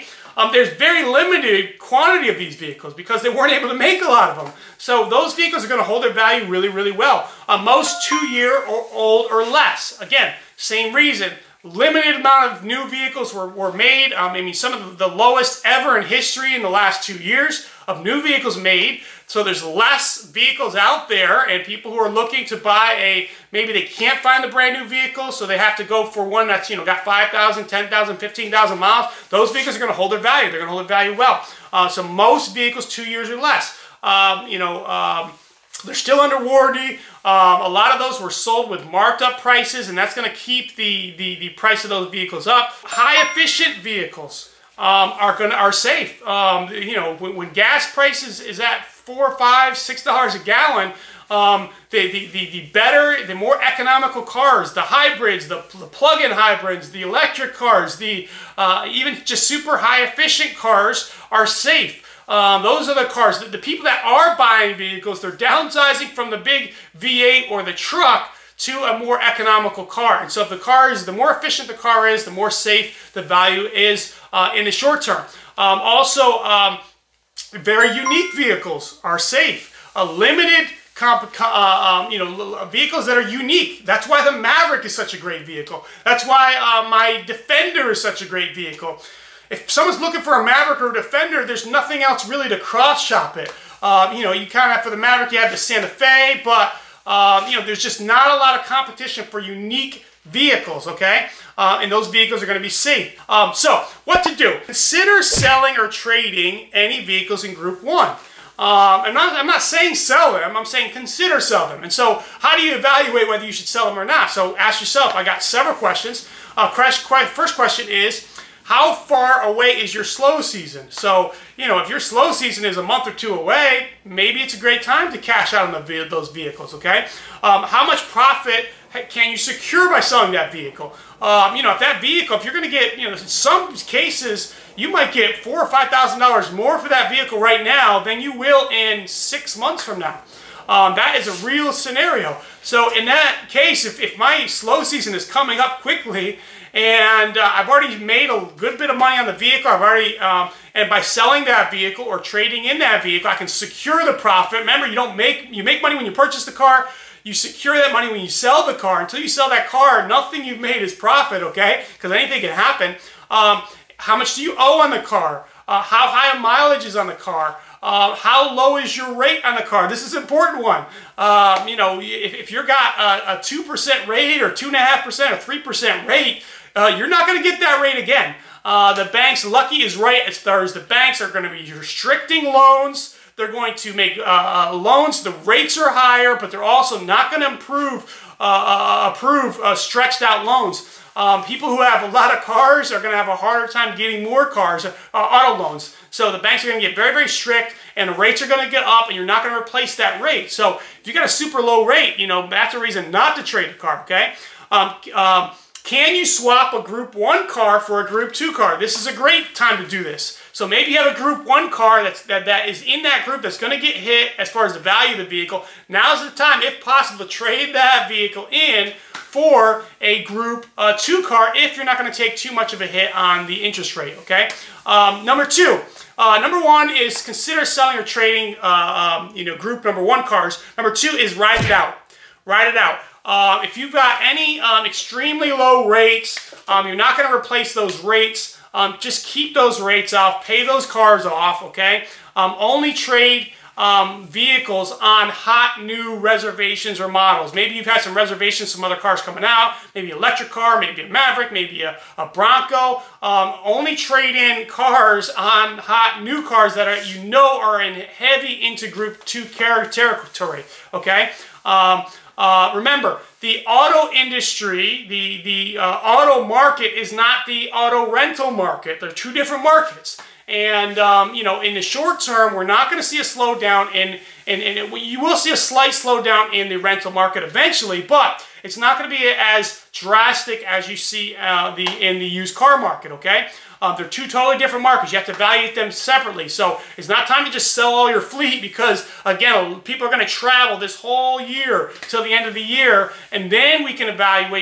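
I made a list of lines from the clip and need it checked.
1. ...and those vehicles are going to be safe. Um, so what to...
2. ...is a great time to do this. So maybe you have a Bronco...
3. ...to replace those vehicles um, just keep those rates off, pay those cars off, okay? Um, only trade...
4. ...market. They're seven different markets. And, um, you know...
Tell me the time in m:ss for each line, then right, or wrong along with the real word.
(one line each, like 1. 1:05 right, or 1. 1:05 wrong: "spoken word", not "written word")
1. 1:41 right
2. 3:28 wrong: "Group", not "Bronco"
3. 3:57 wrong: "rates", not "vehicles"
4. 4:28 wrong: "two", not "seven".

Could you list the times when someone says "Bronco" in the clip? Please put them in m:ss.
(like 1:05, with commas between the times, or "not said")
4:12.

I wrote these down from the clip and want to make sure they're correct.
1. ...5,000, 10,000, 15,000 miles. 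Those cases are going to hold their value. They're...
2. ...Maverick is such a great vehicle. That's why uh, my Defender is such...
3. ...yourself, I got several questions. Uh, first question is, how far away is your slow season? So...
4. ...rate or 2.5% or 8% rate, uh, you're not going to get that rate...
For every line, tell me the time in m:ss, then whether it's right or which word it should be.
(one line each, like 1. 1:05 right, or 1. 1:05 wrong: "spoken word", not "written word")
1. 0:27 wrong: "vehicles", not "cases"
2. 1:24 right
3. 1:54 right
4. 2:54 wrong: "3", not "8".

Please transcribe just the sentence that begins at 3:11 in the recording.
Um, people who have a lot of cars are going to have a harder time getting more cars, uh, auto loans.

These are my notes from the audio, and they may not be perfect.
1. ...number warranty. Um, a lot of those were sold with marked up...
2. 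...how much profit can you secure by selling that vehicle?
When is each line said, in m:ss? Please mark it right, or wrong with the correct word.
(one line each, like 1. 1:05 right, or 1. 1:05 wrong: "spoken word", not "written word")
1. 0:36 wrong: "under", not "number"
2. 2:07 right.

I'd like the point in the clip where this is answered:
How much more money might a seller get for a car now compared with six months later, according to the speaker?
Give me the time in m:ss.
2:15.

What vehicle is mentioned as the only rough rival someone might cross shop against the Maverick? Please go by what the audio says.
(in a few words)
Santa Fe.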